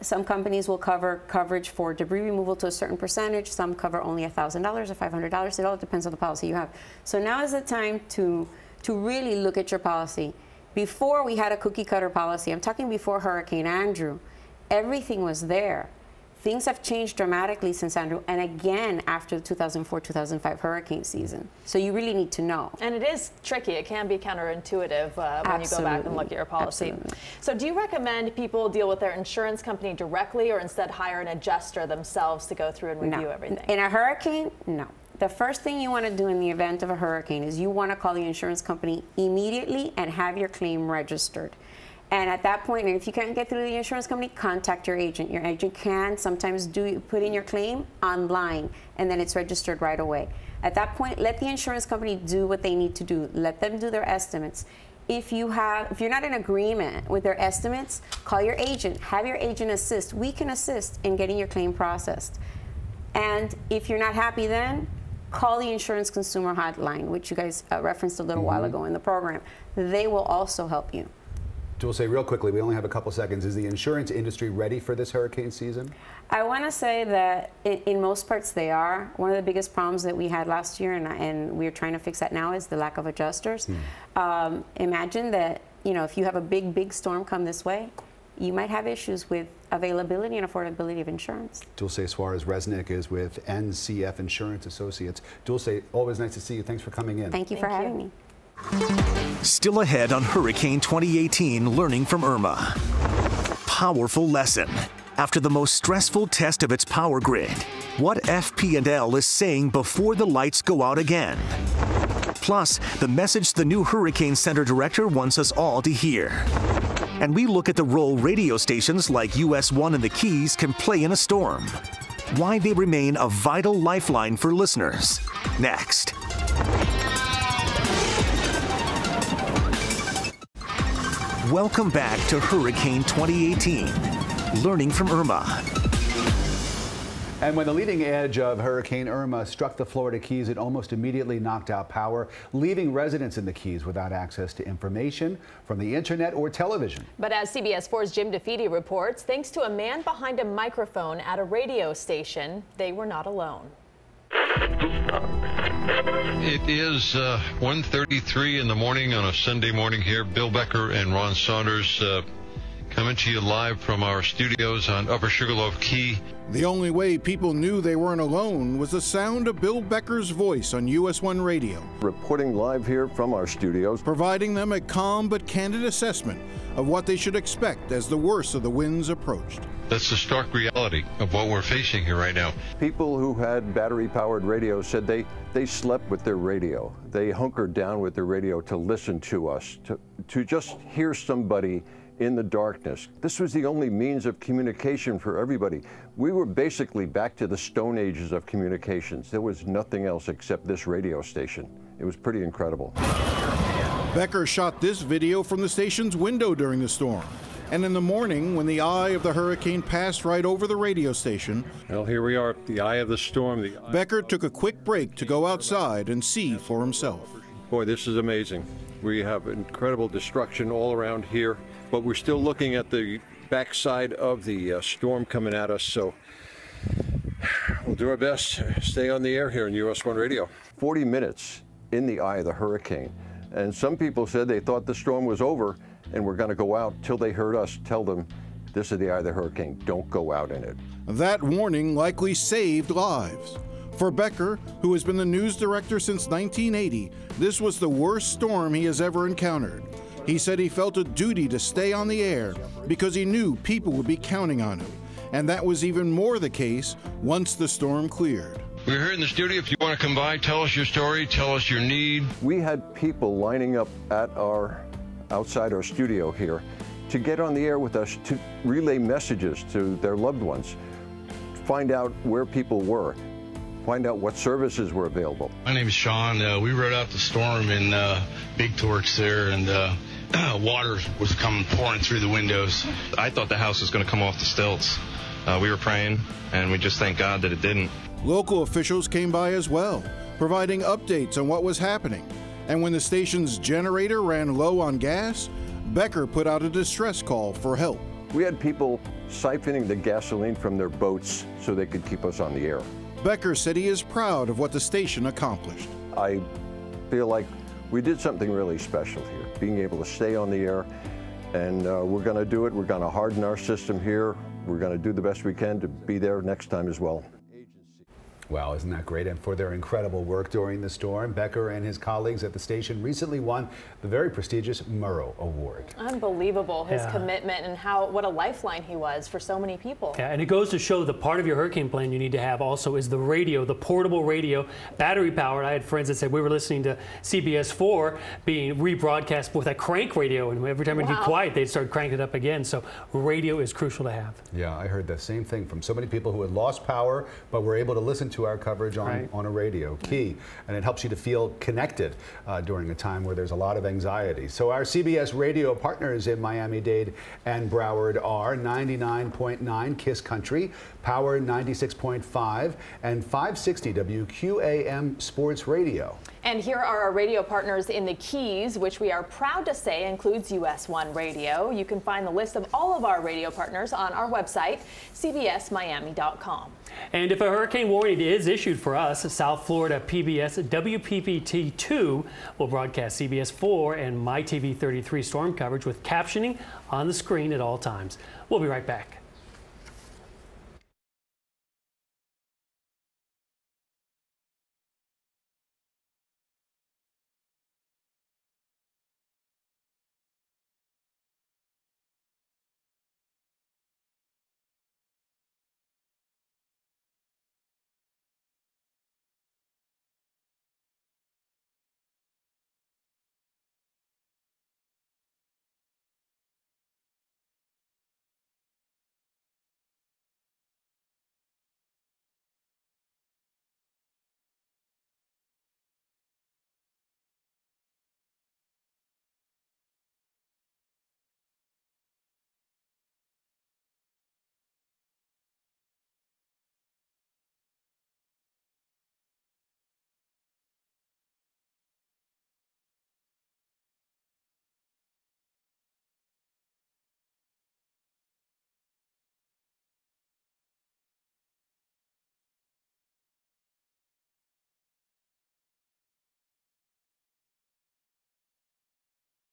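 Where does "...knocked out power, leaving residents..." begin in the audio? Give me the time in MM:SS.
02:21.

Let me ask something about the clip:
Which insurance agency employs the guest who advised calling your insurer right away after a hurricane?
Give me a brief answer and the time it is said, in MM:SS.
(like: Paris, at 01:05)
NCF Insurance Associates, at 01:33.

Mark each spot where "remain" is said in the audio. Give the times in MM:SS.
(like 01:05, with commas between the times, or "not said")
02:02.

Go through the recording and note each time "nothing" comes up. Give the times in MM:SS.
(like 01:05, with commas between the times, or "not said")
03:19.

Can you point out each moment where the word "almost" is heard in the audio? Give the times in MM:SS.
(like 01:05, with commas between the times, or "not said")
02:20.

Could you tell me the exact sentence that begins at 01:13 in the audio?
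Is the insurance industry ready for this hurricane season?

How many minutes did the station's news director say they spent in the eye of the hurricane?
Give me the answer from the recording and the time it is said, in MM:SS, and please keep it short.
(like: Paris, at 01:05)
40, at 03:50.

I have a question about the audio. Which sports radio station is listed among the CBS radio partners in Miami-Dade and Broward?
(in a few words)
560 WQAM.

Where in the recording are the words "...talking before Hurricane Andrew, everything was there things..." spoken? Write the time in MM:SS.
00:12.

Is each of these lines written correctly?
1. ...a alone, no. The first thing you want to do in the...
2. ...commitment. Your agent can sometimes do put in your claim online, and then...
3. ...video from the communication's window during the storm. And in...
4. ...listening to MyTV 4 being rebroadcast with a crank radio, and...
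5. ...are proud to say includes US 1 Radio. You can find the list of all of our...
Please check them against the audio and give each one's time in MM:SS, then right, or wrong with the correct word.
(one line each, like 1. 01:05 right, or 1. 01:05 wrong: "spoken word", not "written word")
1. 00:33 wrong: "hurricane", not "alone"
2. 00:44 wrong: "agent", not "commitment"
3. 03:25 wrong: "station", not "communication"
4. 05:36 wrong: "CBS", not "MyTV"
5. 06:09 right.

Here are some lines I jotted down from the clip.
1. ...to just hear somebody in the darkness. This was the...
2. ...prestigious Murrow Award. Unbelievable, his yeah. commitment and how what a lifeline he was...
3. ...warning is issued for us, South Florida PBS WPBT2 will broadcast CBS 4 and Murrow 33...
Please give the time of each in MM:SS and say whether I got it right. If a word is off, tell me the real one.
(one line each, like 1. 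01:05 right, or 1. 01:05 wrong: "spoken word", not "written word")
1. 03:10 right
2. 05:24 right
3. 06:17 wrong: "MyTV", not "Murrow".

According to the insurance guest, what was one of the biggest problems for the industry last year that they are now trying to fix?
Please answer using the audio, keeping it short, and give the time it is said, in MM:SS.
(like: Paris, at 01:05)
lack of adjusters, at 01:22.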